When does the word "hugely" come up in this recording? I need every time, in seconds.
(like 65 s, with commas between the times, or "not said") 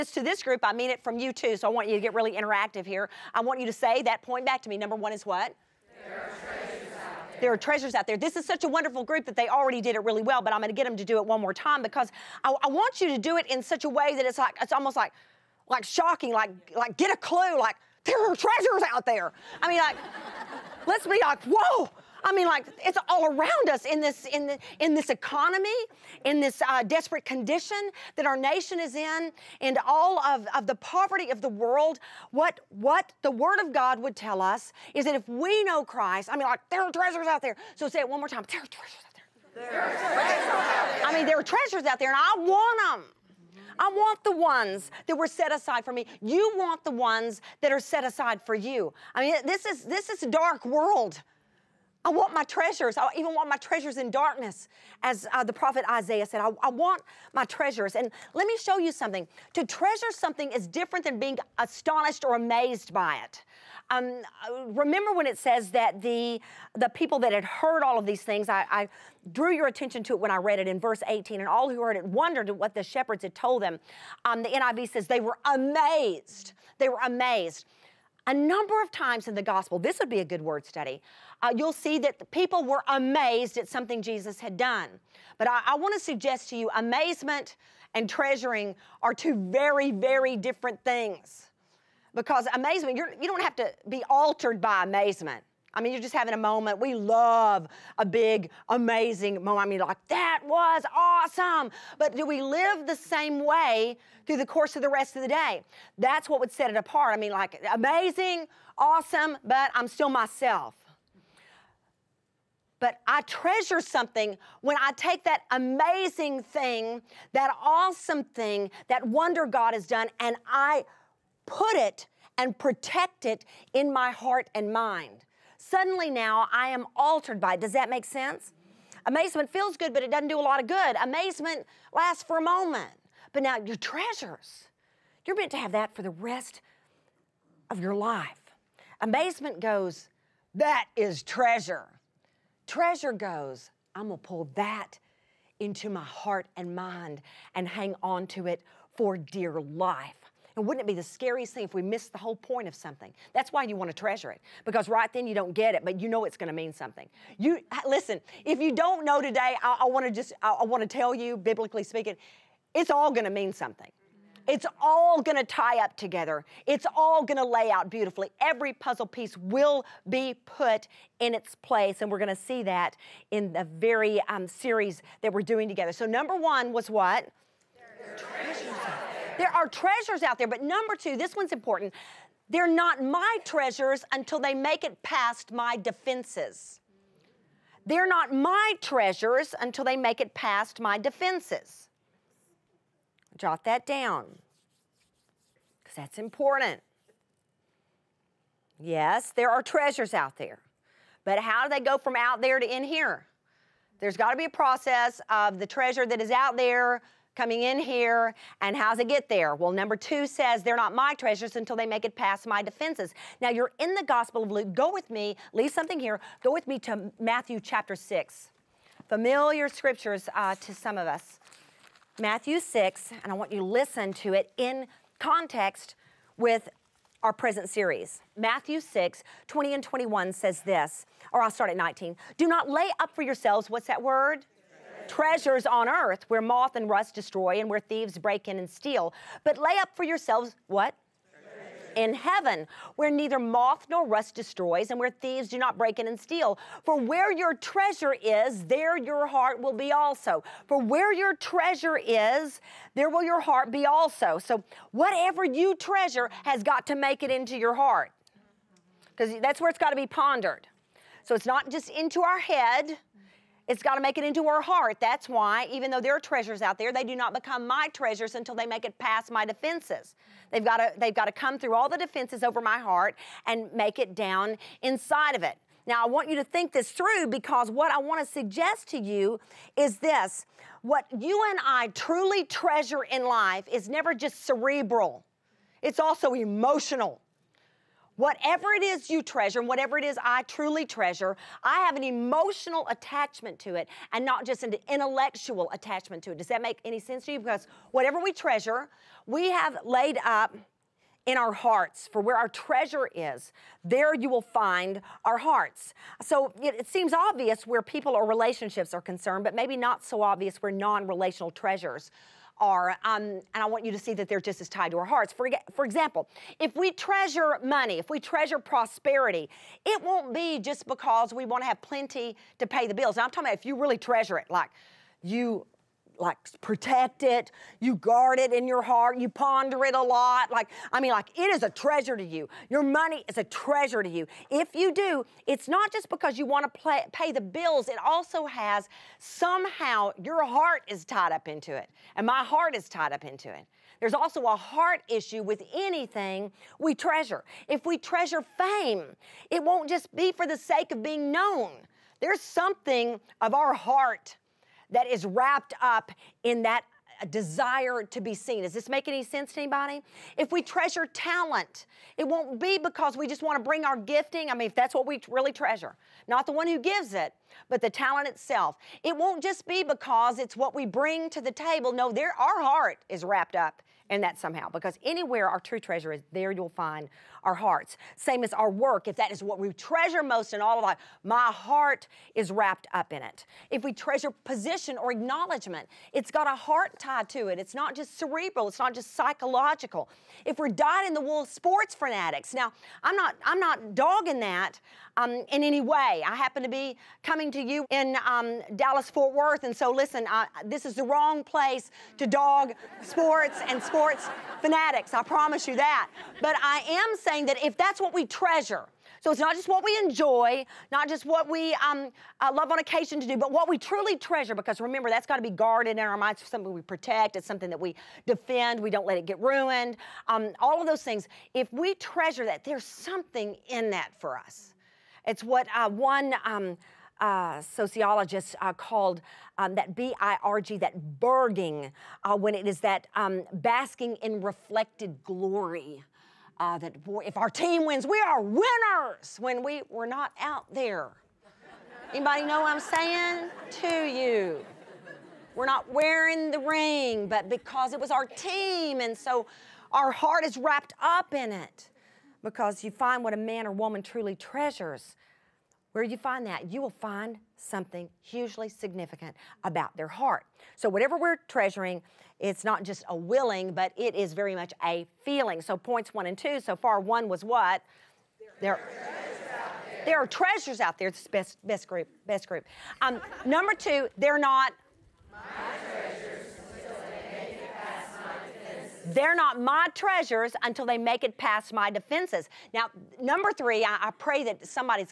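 458 s.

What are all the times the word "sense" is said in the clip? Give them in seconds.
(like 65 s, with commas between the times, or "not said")
128 s, 296 s, 359 s.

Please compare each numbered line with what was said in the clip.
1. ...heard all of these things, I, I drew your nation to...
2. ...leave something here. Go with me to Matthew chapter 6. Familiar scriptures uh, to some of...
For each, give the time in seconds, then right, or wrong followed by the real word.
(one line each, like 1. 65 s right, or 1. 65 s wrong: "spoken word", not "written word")
1. 67 s wrong: "attention", not "nation"
2. 215 s right.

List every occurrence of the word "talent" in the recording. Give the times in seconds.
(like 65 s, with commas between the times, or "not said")
361 s, 367 s.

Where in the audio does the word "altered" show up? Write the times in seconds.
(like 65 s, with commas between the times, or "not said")
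94 s, 126 s.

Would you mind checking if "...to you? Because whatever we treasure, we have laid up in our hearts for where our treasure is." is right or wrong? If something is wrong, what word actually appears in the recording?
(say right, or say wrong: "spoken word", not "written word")
right.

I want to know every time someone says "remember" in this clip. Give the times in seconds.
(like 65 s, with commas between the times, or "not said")
64 s, 414 s.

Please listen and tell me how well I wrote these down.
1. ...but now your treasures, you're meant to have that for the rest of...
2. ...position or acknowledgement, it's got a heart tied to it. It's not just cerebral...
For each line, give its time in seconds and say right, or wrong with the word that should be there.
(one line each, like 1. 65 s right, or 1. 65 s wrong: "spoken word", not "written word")
1. 133 s right
2. 384 s right.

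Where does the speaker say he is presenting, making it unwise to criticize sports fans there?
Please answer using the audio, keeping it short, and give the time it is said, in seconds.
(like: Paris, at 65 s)
Dallas Fort Worth, at 398 s.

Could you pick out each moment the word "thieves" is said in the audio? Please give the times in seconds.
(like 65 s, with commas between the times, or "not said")
237 s, 245 s.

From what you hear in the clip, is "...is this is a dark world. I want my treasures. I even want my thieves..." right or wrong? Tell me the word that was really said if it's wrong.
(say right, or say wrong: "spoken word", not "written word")
wrong: "treasures", not "thieves".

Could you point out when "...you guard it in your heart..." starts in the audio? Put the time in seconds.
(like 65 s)
327 s.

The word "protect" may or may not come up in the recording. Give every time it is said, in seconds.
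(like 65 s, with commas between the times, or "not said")
122 s, 326 s, 416 s.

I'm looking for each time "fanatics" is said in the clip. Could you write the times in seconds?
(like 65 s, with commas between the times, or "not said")
391 s, 404 s.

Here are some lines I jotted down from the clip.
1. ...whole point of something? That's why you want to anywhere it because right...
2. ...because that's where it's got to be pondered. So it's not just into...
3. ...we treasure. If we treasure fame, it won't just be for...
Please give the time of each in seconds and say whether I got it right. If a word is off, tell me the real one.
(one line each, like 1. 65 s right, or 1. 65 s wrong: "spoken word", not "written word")
1. 152 s wrong: "treasure", not "anywhere"
2. 259 s right
3. 346 s right.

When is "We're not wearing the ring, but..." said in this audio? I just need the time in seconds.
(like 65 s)
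445 s.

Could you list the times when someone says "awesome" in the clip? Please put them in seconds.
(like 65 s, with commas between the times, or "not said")
100 s, 108 s, 117 s.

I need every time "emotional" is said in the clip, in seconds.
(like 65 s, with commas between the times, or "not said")
286 s, 292 s.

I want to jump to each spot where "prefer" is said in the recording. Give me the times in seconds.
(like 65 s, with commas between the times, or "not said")
not said.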